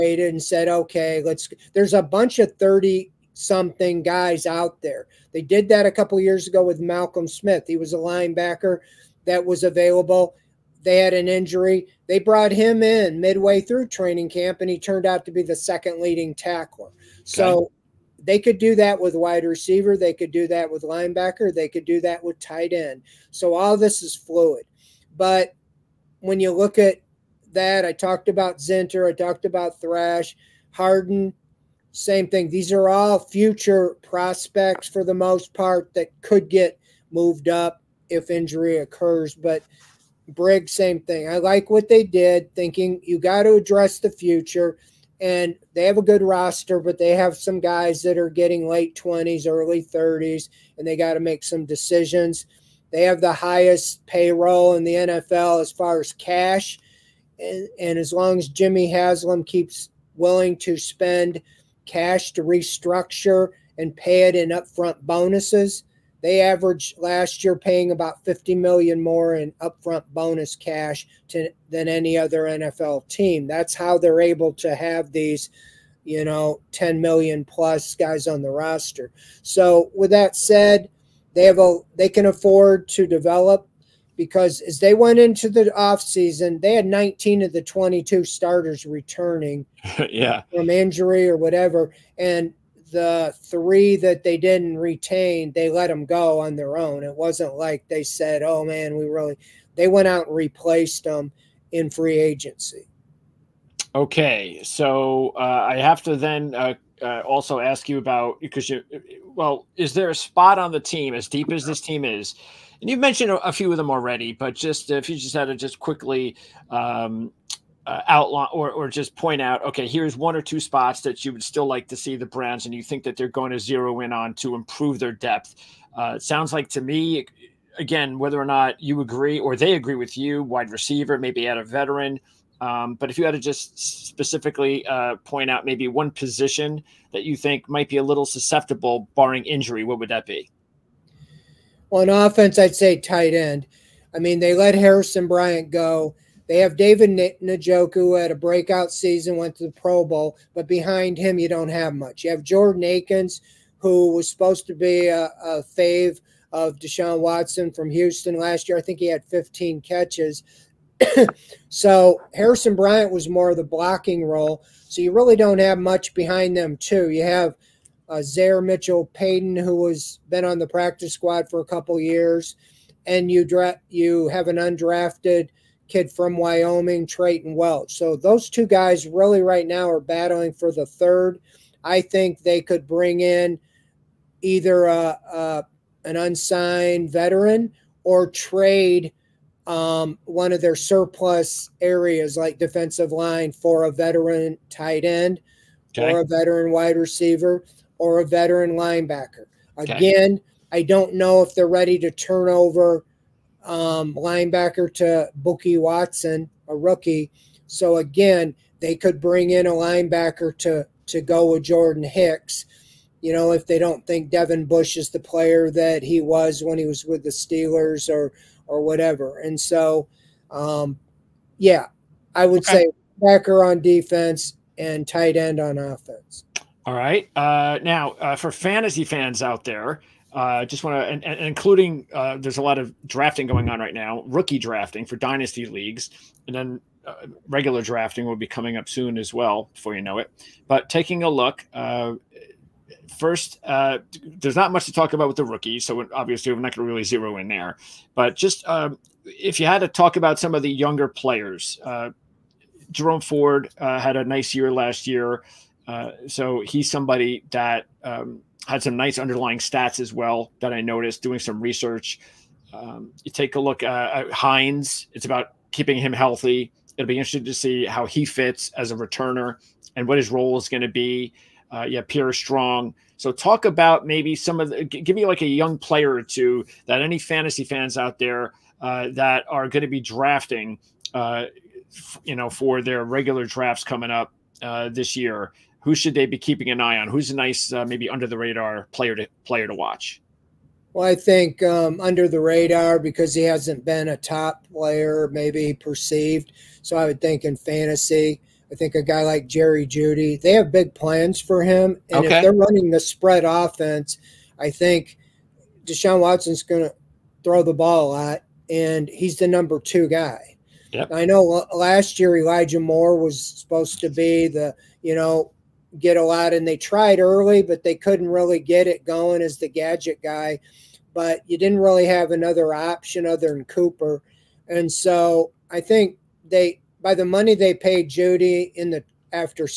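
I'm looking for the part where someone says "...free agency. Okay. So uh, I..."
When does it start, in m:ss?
1:41.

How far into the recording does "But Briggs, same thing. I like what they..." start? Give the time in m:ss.
0:39.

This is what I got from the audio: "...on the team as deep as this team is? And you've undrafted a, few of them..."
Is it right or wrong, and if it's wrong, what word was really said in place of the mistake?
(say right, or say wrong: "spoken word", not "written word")
wrong: "mentioned", not "undrafted".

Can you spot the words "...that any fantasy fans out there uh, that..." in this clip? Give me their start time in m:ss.
4:36.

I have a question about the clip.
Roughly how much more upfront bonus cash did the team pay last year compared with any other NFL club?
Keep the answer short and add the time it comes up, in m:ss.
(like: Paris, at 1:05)
50 million, at 1:08.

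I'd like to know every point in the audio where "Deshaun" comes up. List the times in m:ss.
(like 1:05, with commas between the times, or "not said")
2:36, 5:05.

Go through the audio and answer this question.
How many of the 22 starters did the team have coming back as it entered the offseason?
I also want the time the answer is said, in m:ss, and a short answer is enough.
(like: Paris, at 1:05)
19, at 1:26.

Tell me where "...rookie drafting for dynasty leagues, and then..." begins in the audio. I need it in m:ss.
3:54.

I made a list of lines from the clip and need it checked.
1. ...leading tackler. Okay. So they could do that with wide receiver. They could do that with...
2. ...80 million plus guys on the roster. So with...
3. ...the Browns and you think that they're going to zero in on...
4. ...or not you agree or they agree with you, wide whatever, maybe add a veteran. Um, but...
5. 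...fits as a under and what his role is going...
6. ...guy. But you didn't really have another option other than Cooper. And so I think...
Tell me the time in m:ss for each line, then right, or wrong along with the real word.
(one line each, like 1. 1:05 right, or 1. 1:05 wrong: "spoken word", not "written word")
1. 0:16 right
2. 1:16 wrong: "10", not "80"
3. 2:02 right
4. 2:08 wrong: "receiver", not "whatever"
5. 4:28 wrong: "returner", not "under"
6. 5:20 right.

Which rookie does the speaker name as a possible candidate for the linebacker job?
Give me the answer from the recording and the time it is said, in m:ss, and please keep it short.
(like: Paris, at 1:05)
Bookie Watson, at 3:25.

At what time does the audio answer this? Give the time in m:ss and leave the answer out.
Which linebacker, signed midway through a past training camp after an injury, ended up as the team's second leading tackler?
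0:06.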